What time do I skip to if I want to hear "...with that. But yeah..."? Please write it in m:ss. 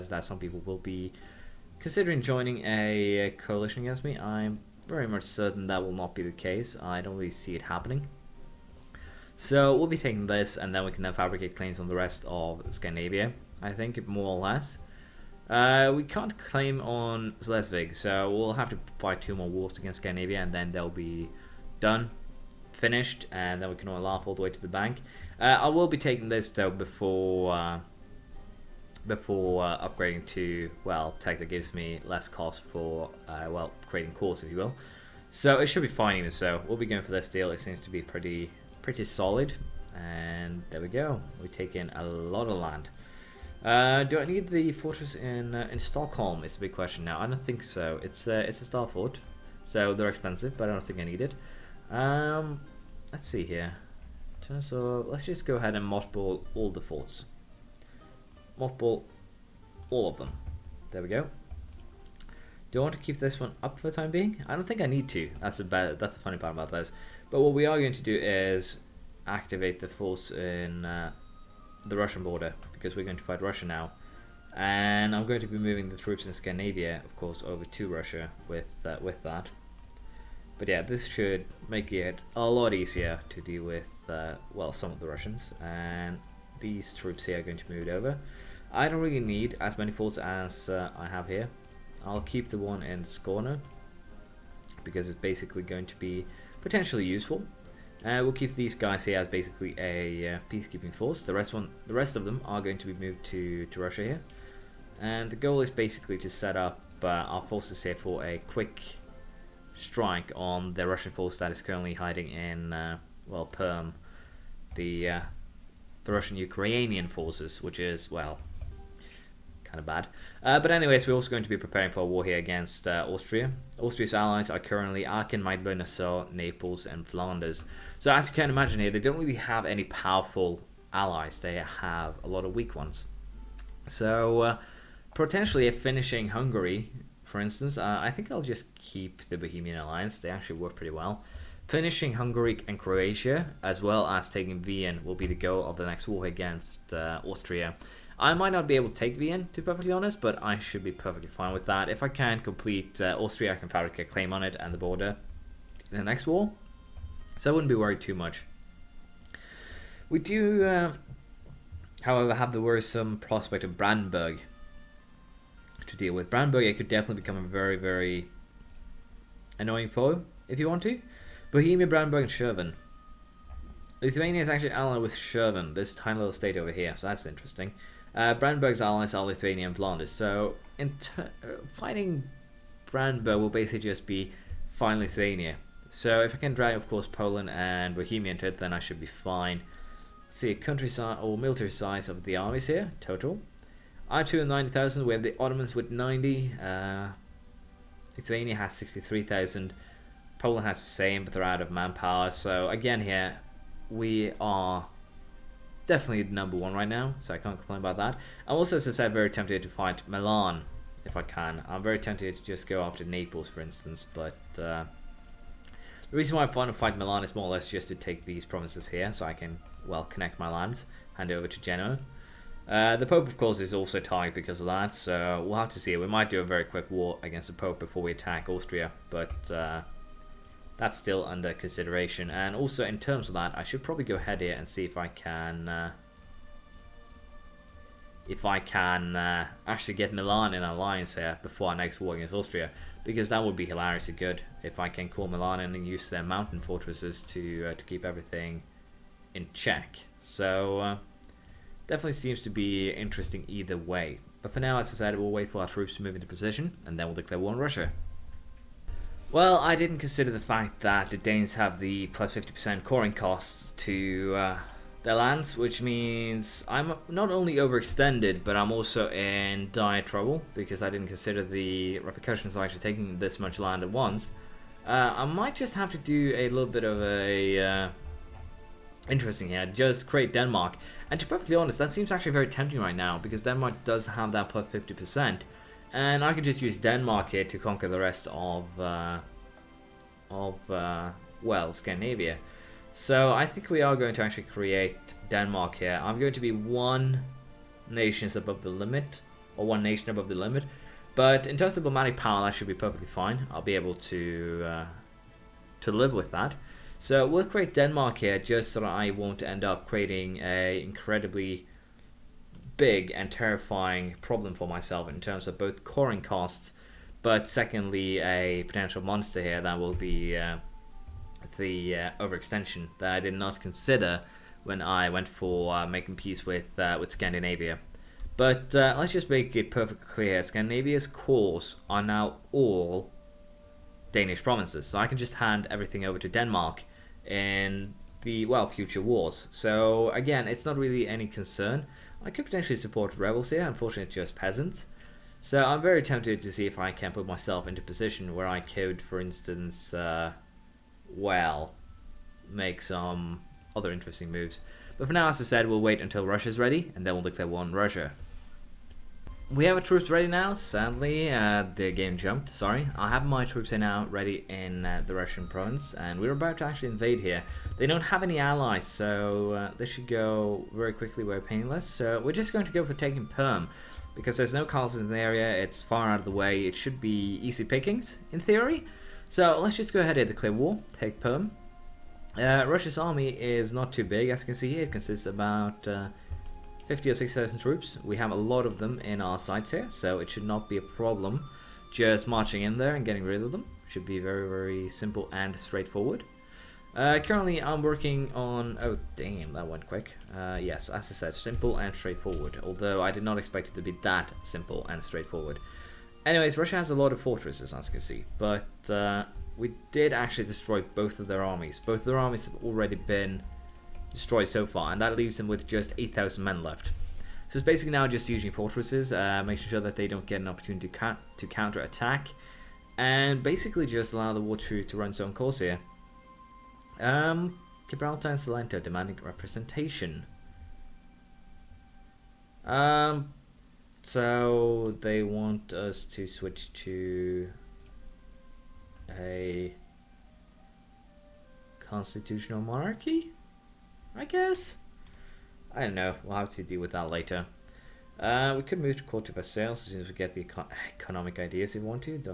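1:19.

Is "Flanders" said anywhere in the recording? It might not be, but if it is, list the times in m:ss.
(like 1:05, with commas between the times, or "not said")
2:07, 2:59.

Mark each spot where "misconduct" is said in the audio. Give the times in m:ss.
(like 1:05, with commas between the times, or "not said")
not said.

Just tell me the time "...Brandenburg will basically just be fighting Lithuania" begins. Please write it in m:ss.
3:02.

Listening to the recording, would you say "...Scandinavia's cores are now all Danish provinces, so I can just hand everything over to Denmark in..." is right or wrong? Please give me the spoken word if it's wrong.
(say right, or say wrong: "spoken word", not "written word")
right.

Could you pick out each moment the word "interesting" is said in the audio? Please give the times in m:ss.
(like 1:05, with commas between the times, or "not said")
2:57, 4:12, 4:39, 5:53.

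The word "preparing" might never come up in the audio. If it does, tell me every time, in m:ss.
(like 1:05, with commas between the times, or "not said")
2:01.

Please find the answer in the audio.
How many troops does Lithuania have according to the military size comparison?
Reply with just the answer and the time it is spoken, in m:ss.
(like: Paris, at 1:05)
63,000, at 3:18.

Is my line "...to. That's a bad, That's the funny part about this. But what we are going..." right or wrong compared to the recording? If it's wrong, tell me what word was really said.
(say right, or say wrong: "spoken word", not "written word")
right.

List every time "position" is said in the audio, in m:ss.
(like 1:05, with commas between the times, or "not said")
4:16, 5:47.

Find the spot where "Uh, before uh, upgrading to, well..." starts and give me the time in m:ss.
0:27.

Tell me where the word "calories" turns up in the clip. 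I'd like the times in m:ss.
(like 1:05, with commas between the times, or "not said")
not said.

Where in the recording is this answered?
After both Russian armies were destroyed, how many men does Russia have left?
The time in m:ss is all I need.
6:55.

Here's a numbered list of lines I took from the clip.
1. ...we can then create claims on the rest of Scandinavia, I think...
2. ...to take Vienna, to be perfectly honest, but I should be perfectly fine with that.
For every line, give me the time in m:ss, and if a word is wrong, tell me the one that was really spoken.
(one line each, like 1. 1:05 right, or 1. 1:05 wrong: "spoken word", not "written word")
1. 0:10 wrong: "fabricate", not "create"
2. 2:28 right.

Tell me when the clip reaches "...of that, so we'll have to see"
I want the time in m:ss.
3:44.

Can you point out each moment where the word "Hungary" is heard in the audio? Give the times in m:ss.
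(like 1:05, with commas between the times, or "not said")
2:16, 2:22.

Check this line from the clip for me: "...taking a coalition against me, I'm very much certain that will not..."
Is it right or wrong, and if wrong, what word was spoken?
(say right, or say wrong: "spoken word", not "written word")
wrong: "joining", not "taking".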